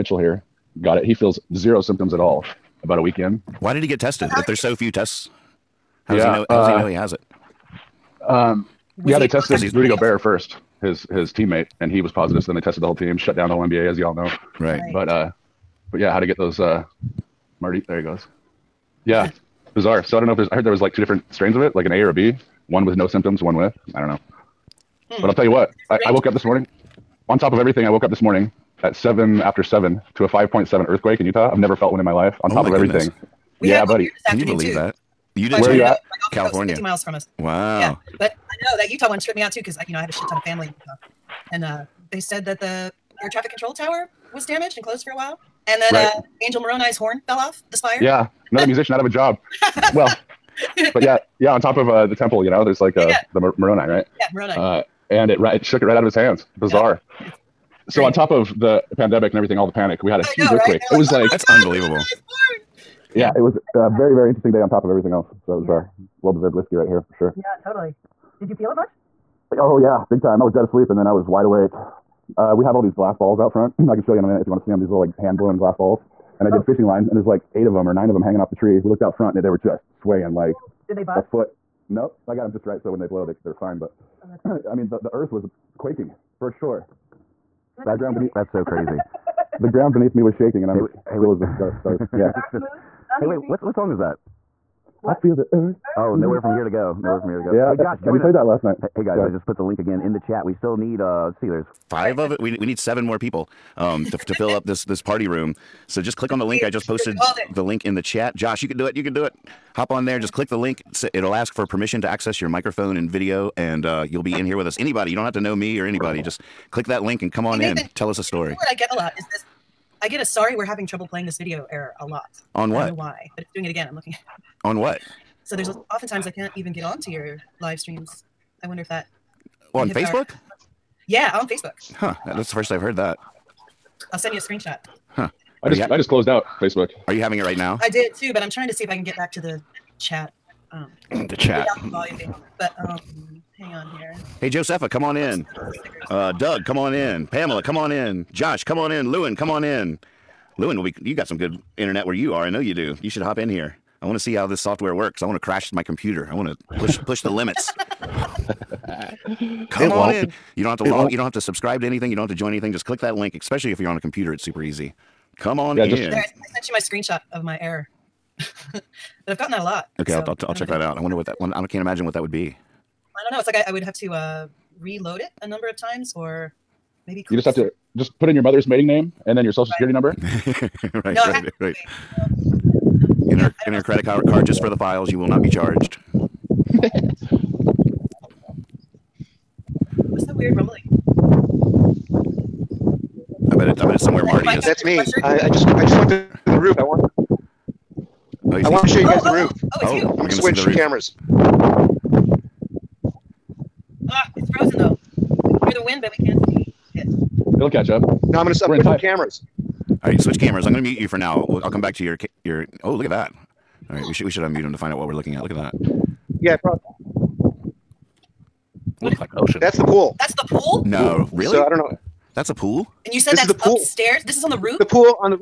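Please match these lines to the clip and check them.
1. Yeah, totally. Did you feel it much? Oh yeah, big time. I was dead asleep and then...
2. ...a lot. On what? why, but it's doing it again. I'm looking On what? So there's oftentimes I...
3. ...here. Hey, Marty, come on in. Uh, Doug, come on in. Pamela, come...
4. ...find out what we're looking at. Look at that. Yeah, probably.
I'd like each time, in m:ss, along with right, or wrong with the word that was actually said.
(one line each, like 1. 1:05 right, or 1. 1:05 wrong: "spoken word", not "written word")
1. 1:07 right
2. 2:01 right
3. 2:23 wrong: "Josepha", not "Marty"
4. 3:34 right.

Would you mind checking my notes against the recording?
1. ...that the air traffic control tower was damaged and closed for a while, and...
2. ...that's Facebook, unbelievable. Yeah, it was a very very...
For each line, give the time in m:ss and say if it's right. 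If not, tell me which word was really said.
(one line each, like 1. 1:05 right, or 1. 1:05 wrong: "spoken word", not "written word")
1. 0:42 right
2. 1:01 wrong: "God", not "Facebook".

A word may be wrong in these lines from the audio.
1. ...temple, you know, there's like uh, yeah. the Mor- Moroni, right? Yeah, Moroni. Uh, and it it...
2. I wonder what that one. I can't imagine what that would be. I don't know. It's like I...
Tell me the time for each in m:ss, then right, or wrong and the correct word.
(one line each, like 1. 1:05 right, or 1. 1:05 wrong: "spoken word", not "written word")
1. 0:52 right
2. 2:50 right.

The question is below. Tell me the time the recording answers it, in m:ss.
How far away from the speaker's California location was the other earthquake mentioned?
0:36.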